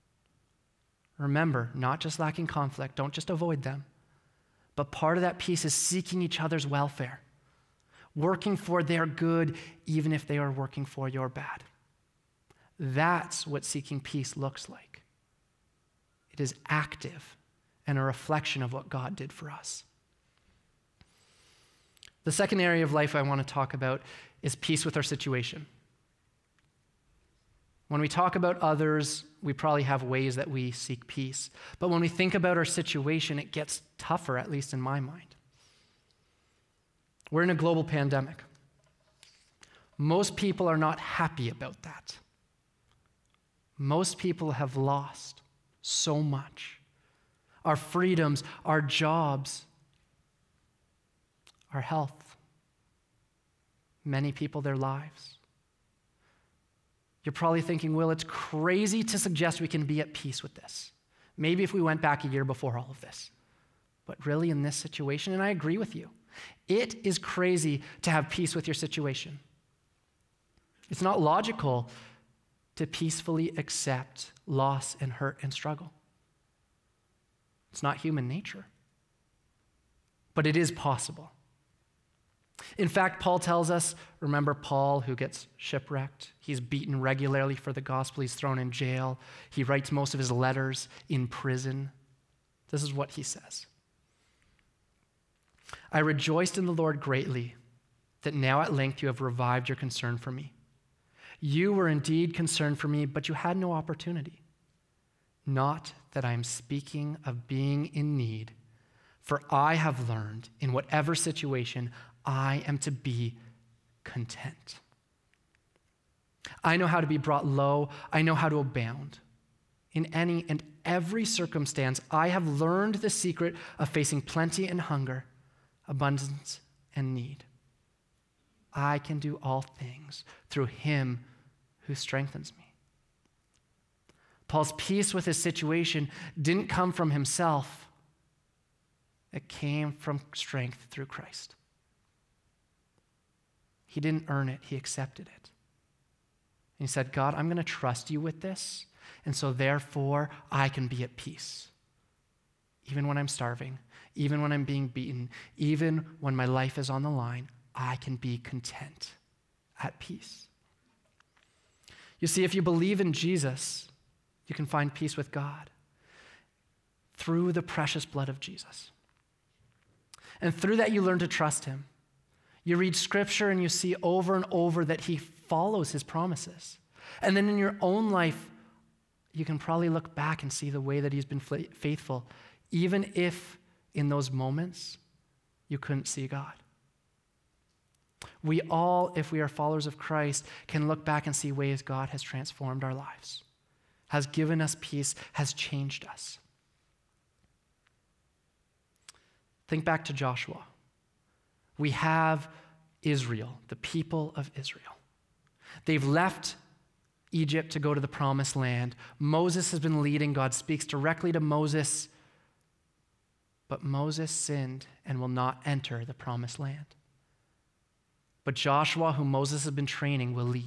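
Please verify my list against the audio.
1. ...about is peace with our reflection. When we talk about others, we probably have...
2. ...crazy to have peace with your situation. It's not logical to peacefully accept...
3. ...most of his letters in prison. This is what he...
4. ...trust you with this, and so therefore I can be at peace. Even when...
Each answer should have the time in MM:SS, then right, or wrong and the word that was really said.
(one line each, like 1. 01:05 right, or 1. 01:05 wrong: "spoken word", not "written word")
1. 00:23 wrong: "situation", not "reflection"
2. 01:07 right
3. 01:29 right
4. 02:27 right.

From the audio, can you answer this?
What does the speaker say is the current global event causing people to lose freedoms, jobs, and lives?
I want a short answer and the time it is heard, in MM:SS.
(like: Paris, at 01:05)
Global pandemic, at 00:37.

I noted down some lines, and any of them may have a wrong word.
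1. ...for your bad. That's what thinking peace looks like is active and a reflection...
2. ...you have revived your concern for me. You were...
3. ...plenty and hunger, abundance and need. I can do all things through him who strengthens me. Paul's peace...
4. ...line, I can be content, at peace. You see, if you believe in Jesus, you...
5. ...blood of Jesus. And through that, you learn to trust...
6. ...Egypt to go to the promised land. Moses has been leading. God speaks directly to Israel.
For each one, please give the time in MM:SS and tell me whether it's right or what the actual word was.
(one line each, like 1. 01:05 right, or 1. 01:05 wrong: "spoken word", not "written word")
1. 00:10 wrong: "seeking", not "thinking"
2. 01:39 right
3. 02:04 right
4. 02:37 right
5. 02:48 right
6. 03:27 wrong: "Moses", not "Israel".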